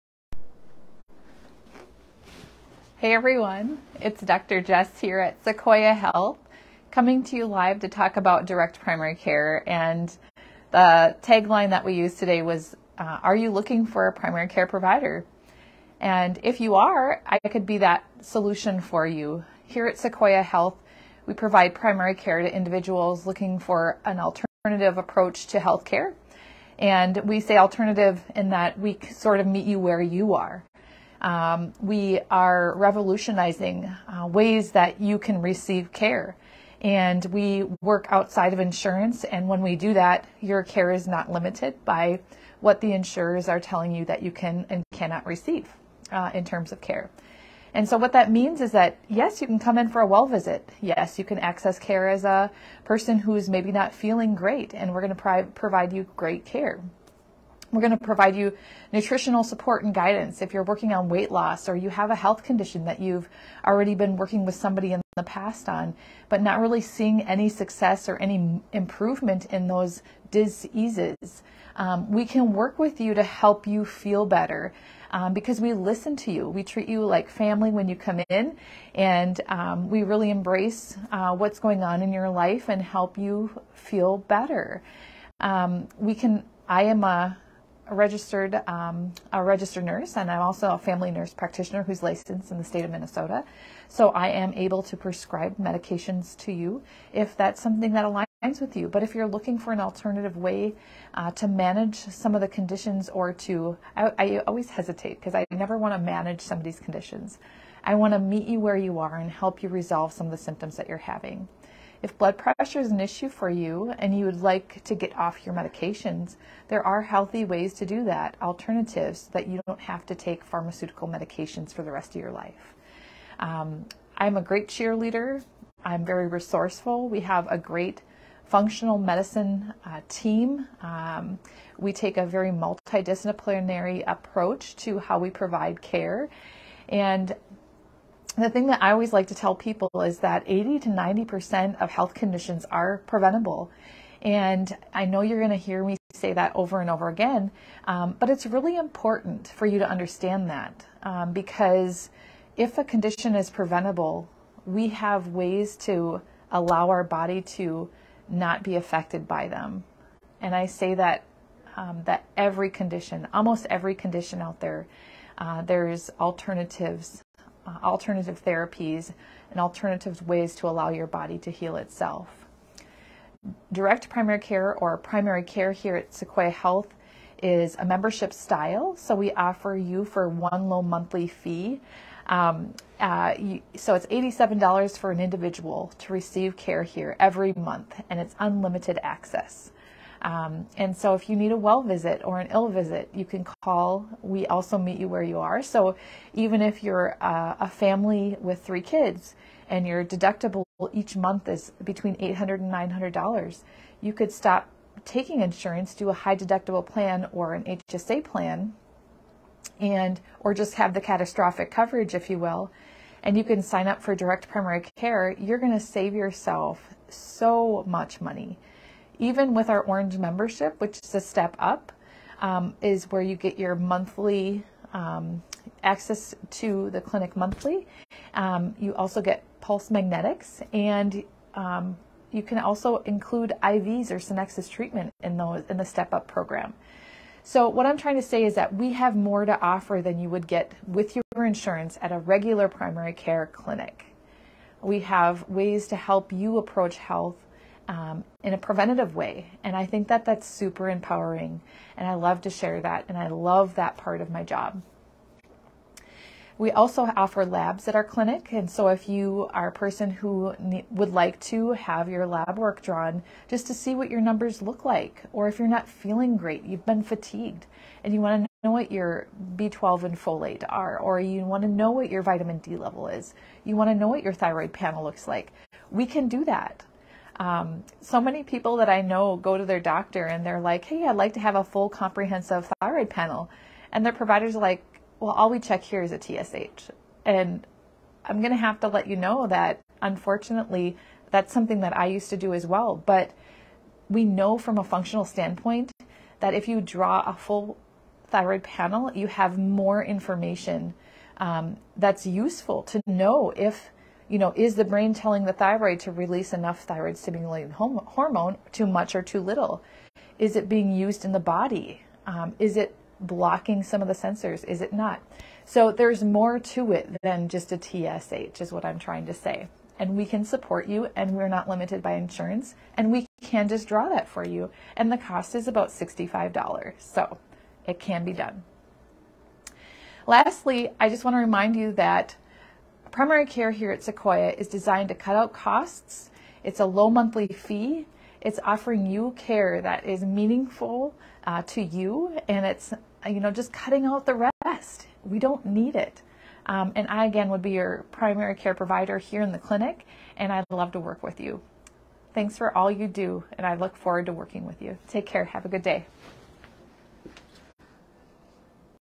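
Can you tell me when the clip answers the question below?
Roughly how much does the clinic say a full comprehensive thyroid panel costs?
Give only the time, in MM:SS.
05:25.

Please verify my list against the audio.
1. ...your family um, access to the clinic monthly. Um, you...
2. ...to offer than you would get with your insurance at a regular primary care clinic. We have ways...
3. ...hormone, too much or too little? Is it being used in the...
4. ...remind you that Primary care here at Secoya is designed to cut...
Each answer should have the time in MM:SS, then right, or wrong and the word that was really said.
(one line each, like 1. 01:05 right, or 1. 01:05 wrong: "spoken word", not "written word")
1. 03:43 wrong: "monthly", not "family"
2. 03:59 right
3. 05:07 right
4. 05:31 right.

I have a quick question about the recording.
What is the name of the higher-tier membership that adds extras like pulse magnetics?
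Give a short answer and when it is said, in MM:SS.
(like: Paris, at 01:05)
Orange, at 03:39.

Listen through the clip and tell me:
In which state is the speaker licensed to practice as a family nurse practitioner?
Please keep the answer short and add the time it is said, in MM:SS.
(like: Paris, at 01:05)
Minnesota, at 01:32.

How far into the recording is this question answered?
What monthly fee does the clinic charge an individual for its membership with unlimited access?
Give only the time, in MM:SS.
03:04.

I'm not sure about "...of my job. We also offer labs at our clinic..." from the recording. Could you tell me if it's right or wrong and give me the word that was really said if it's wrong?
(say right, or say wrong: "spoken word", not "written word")
right.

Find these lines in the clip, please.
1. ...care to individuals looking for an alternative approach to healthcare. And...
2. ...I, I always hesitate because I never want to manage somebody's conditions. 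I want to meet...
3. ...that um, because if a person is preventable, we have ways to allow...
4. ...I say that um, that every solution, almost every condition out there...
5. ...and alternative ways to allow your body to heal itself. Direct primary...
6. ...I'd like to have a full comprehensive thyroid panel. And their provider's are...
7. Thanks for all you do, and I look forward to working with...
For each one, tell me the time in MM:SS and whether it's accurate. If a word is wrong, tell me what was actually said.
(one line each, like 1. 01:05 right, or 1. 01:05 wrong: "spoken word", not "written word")
1. 00:22 right
2. 01:43 right
3. 02:30 wrong: "condition", not "person"
4. 02:40 wrong: "condition", not "solution"
5. 02:49 right
6. 04:41 right
7. 05:52 right.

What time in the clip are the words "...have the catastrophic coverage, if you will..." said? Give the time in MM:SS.
03:30.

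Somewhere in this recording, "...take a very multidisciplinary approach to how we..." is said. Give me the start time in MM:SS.
02:11.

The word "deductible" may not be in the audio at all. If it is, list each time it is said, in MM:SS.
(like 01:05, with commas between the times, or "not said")
03:20, 03:26.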